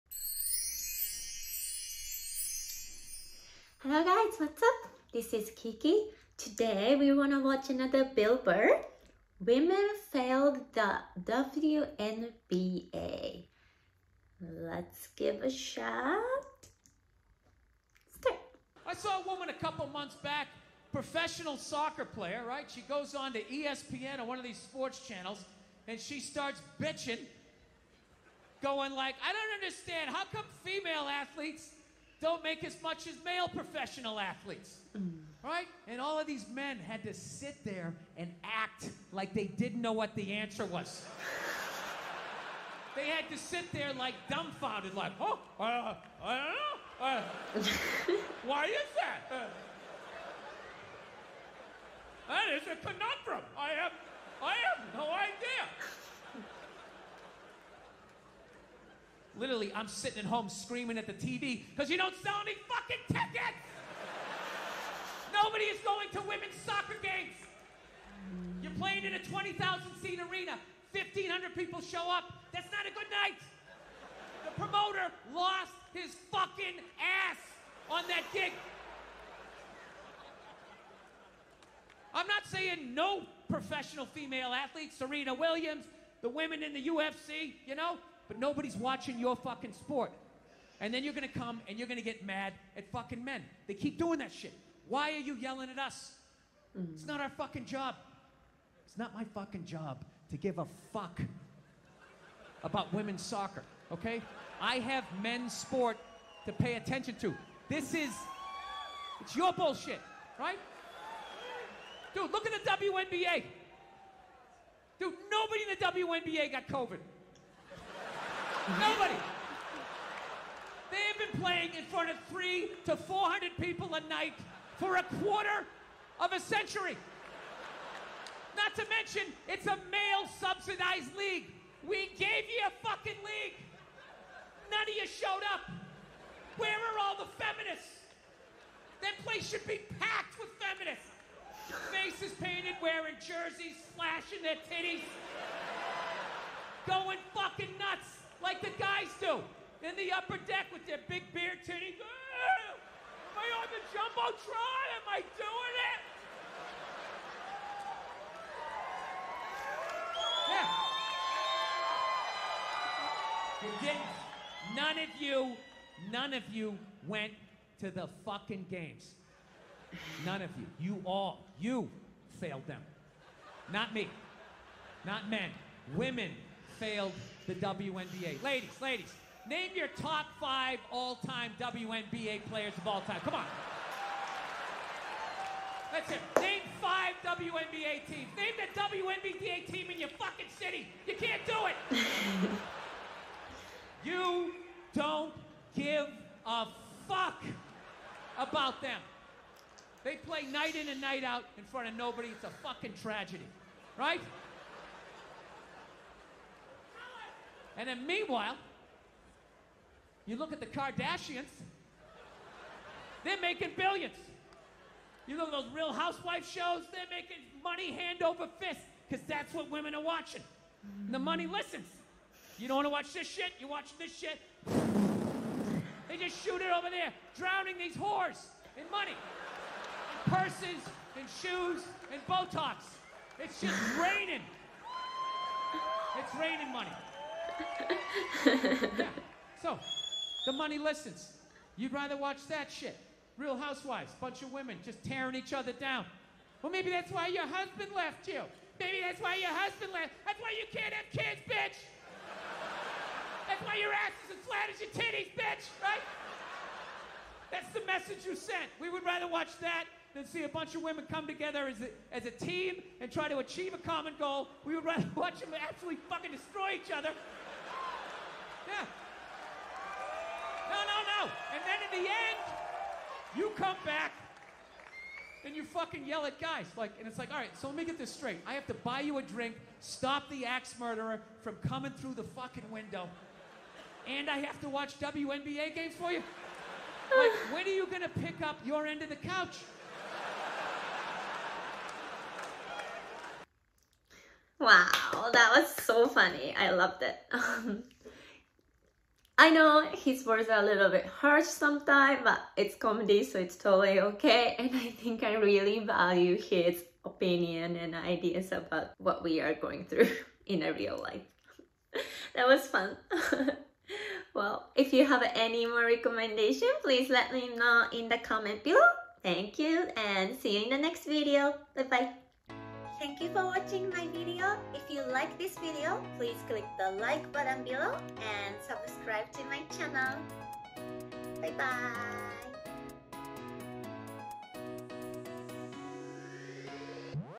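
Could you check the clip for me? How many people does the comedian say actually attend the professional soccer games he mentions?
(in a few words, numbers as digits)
1,500.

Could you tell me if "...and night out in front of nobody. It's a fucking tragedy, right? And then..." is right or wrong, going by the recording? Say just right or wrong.
right.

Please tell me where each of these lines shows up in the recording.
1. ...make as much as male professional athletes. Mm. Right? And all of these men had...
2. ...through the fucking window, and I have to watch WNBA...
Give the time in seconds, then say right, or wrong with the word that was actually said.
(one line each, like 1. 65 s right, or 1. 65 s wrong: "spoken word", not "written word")
1. 32 s right
2. 281 s right.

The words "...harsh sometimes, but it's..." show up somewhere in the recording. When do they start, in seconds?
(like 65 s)
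301 s.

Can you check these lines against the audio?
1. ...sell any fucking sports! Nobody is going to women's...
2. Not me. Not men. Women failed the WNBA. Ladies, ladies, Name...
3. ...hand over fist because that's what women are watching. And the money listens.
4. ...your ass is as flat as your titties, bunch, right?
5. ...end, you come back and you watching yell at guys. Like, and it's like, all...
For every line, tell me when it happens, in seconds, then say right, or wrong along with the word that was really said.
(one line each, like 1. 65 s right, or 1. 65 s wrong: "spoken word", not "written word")
1. 62 s wrong: "tickets", not "sports"
2. 173 s right
3. 217 s right
4. 253 s wrong: "bitch", not "bunch"
5. 272 s wrong: "fucking", not "watching".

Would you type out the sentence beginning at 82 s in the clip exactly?
I'm not saying no professional female athletes, Serena Williams, the women in the UFC, you know, but nobody's watching your fucking sport.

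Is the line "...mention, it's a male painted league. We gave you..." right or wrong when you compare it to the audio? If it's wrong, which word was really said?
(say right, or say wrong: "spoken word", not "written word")
wrong: "subsidized", not "painted".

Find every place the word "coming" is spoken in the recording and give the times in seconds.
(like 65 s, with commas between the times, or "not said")
281 s.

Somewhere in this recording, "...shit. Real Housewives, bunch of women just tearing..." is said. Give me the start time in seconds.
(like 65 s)
242 s.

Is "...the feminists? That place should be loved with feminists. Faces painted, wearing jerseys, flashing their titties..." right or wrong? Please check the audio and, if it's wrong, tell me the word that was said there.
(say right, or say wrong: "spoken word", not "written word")
wrong: "packed", not "loved".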